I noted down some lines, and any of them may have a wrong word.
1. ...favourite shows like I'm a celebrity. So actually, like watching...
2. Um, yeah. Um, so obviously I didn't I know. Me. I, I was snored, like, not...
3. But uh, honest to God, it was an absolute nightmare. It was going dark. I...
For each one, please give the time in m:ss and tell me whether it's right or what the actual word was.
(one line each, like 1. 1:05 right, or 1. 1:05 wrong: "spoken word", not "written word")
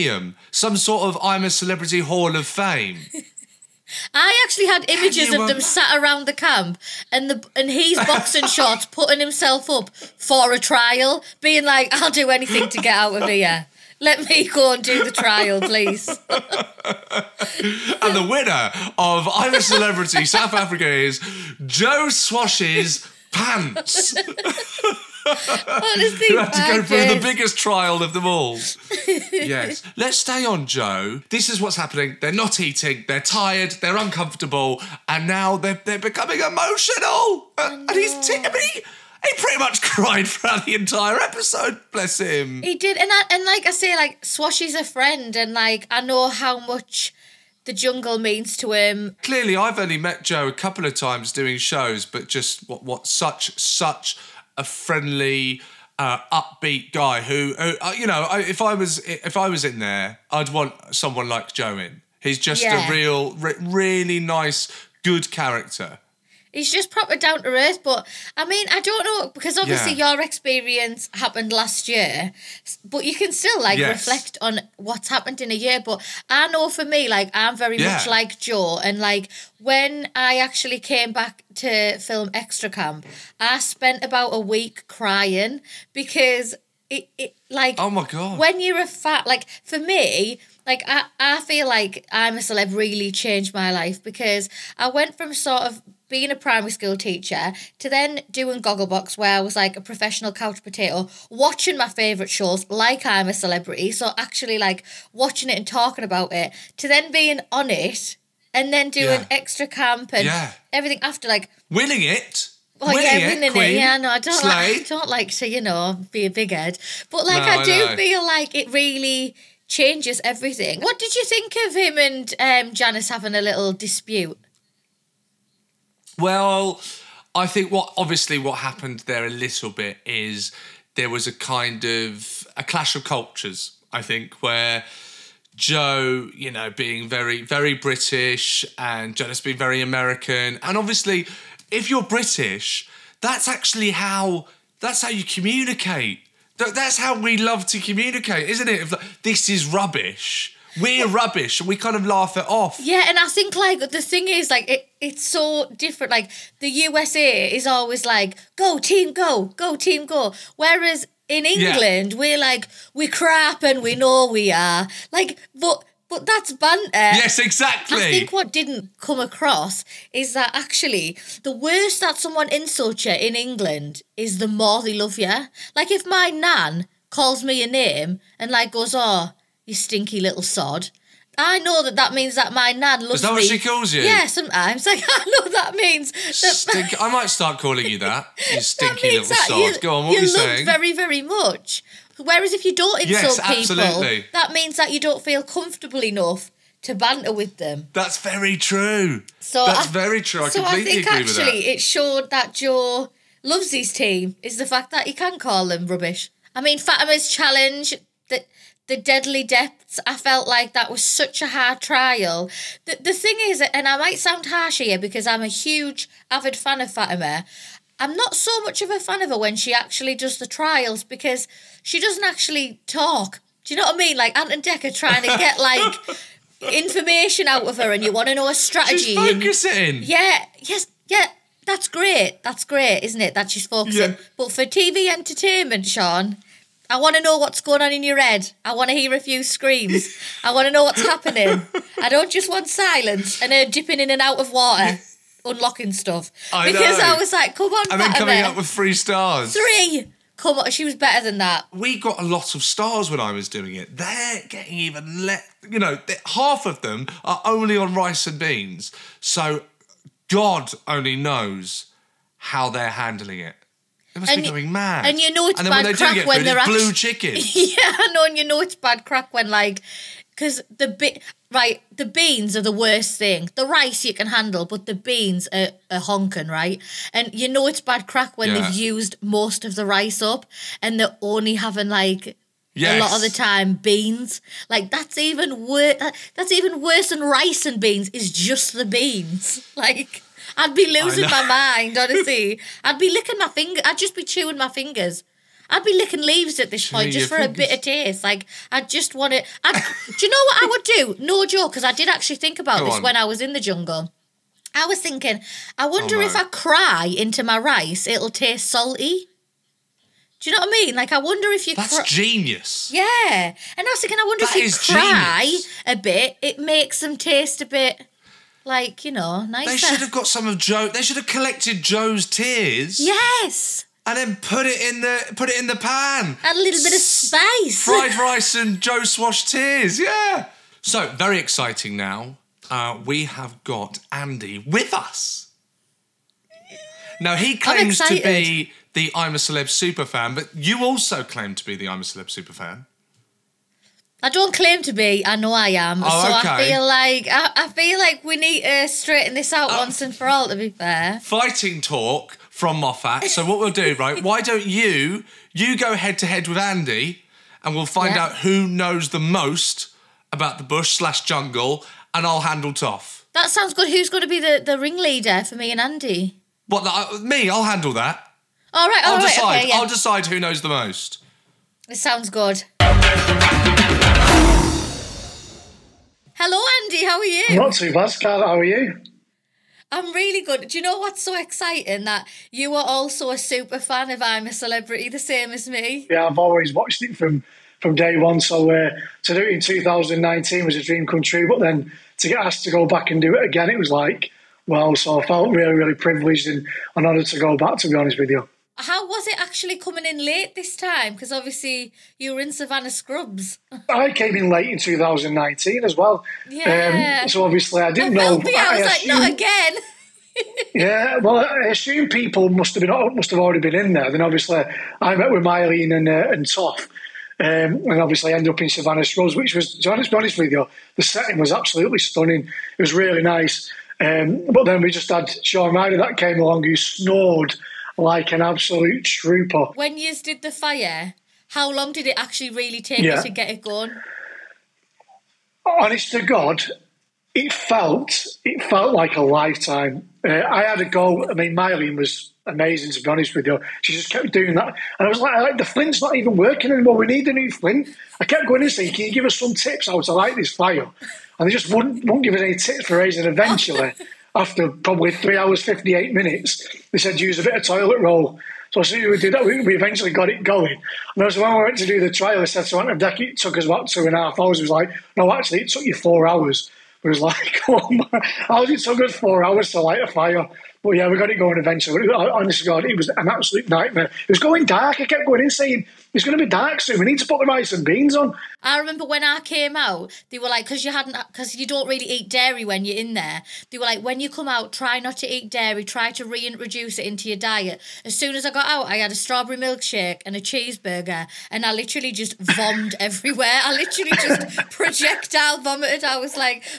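1. 1:41 right
2. 6:46 wrong: "assumed", not "snored"
3. 7:52 right.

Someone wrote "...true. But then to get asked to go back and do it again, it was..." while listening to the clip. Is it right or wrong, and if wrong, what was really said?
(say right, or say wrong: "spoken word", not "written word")
right.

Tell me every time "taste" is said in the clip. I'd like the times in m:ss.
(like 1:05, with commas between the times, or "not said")
4:57, 5:08, 5:17.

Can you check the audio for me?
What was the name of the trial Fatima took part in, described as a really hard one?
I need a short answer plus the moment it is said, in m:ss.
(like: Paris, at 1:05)
The Deadly Depths, at 3:28.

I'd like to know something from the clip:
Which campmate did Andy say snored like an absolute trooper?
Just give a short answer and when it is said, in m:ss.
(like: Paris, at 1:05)
Shaun Ryder, at 7:05.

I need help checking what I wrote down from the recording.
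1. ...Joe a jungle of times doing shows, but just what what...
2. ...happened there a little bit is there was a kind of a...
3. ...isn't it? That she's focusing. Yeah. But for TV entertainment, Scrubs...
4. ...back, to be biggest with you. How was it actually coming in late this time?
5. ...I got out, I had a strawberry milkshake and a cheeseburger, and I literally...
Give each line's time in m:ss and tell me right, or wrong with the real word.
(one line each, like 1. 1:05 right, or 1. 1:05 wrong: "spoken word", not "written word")
1. 0:50 wrong: "couple", not "jungle"
2. 2:08 right
3. 3:53 wrong: "Seann", not "Scrubs"
4. 6:37 wrong: "honest", not "biggest"
5. 8:08 right.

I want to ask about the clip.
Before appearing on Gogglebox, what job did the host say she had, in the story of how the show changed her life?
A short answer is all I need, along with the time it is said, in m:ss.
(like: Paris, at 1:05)
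primary school teacher, at 1:36.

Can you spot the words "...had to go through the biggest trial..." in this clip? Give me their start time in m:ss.
0:26.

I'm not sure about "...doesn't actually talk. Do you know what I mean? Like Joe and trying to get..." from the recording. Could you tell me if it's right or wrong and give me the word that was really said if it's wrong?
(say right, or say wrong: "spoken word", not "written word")
wrong: "Ant", not "Joe".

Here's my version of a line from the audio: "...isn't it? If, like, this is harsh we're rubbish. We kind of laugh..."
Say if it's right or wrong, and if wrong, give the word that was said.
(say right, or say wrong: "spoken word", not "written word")
wrong: "rubbish", not "harsh".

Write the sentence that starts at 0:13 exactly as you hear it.
Let me go and do the trial, please.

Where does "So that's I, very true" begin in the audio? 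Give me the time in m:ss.
3:19.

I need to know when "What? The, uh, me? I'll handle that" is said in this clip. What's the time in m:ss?
6:06.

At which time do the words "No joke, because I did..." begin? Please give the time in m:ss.
5:01.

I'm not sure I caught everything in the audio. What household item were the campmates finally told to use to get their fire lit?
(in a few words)
toilet roll.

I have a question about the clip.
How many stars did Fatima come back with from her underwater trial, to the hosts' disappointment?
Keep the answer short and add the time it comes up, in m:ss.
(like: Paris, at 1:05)
3, at 4:08.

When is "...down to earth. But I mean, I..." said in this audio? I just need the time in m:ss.
1:07.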